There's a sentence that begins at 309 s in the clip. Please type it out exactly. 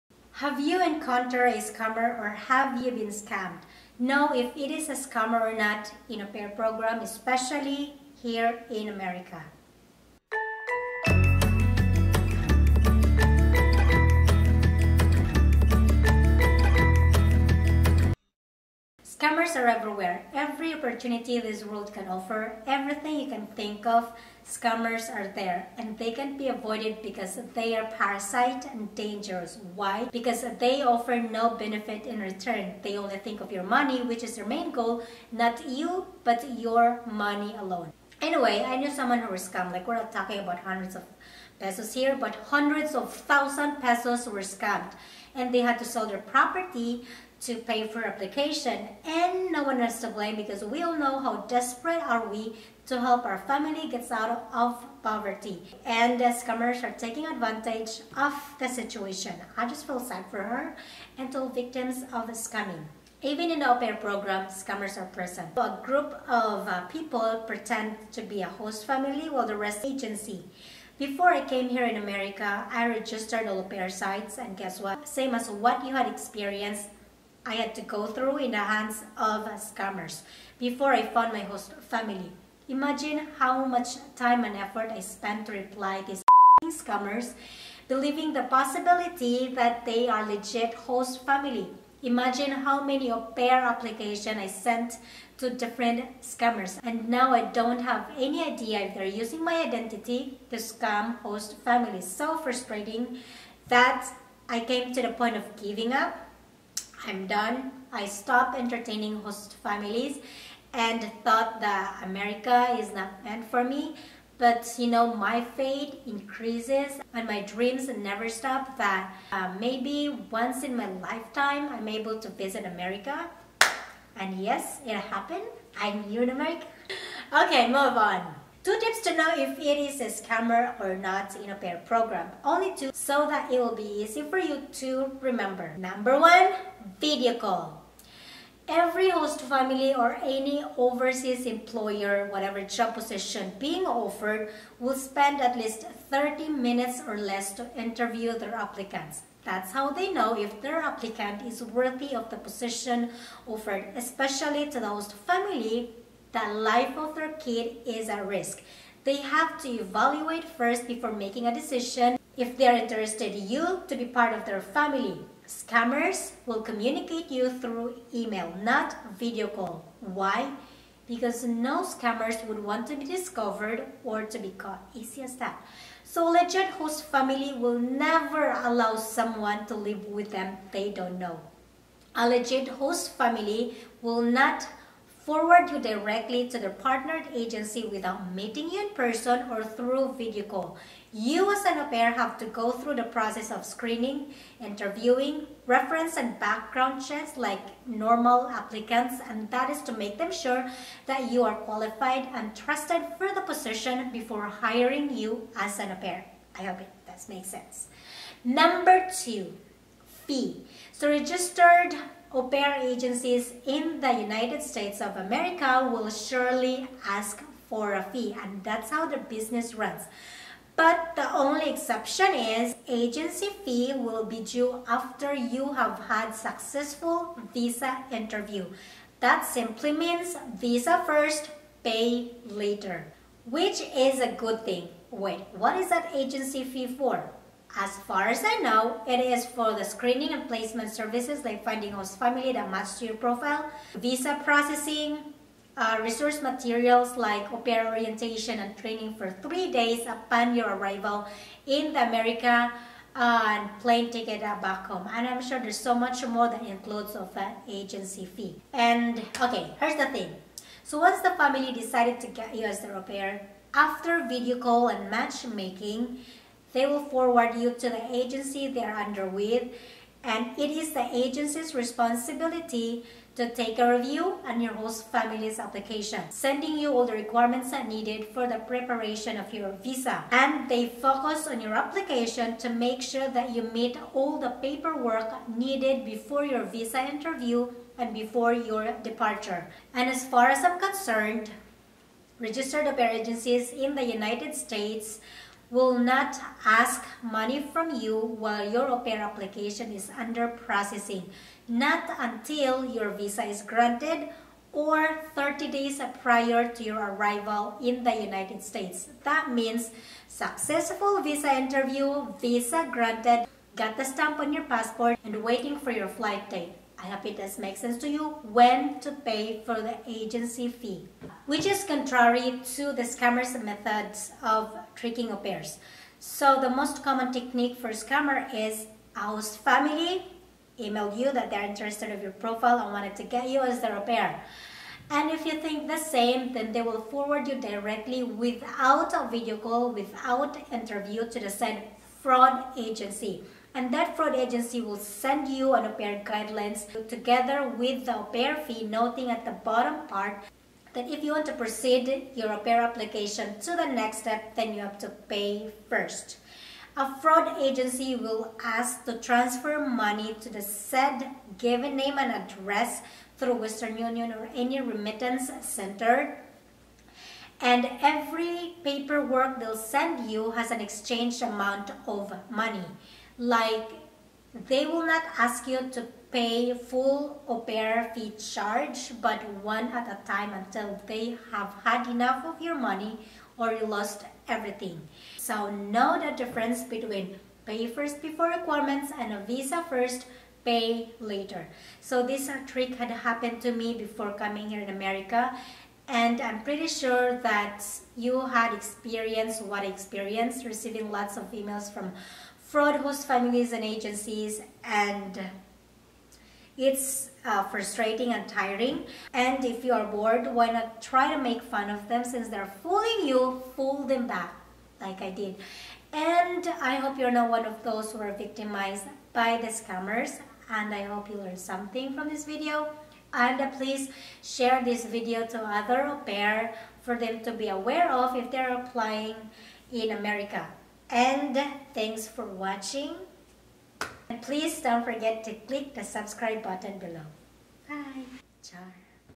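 That means successful visa interview, visa granted, got the stamp on your passport, and waiting for your flight date.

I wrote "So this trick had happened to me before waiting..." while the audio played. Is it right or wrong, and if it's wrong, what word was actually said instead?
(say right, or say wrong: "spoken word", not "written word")
wrong: "coming", not "waiting".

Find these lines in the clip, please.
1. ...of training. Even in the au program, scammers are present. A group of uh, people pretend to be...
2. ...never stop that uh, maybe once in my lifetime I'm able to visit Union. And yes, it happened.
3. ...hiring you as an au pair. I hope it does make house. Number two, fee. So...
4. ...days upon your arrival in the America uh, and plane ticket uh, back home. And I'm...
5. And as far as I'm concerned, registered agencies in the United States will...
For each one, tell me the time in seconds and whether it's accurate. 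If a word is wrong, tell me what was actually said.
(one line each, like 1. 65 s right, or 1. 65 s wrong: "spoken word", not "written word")
1. 62 s wrong: "scamming", not "training"
2. 117 s wrong: "America", not "Union"
3. 204 s wrong: "sense", not "house"
4. 249 s right
5. 289 s right.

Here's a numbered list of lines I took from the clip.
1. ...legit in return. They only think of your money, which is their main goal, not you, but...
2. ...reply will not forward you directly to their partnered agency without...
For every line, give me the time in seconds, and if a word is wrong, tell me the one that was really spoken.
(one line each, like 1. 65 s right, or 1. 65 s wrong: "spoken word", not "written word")
1. 31 s wrong: "benefit", not "legit"
2. 183 s wrong: "family", not "reply".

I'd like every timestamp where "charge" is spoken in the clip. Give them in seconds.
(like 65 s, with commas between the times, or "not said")
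378 s.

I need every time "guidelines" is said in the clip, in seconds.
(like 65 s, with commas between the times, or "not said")
346 s.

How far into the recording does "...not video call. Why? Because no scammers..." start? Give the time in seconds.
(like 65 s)
168 s.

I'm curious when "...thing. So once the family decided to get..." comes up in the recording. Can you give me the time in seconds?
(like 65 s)
260 s.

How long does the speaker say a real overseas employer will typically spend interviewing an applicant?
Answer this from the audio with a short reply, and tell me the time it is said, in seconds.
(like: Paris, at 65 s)
30 minutes or less, at 146 s.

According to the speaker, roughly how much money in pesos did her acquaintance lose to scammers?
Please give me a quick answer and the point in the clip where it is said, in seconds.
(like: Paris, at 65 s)
hundreds of thousand pesos, at 42 s.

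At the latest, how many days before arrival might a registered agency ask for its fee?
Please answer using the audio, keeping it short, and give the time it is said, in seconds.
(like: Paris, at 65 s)
30, at 305 s.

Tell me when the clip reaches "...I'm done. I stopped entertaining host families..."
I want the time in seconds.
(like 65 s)
107 s.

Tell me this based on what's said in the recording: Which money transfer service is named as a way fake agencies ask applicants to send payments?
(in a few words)
Western Union.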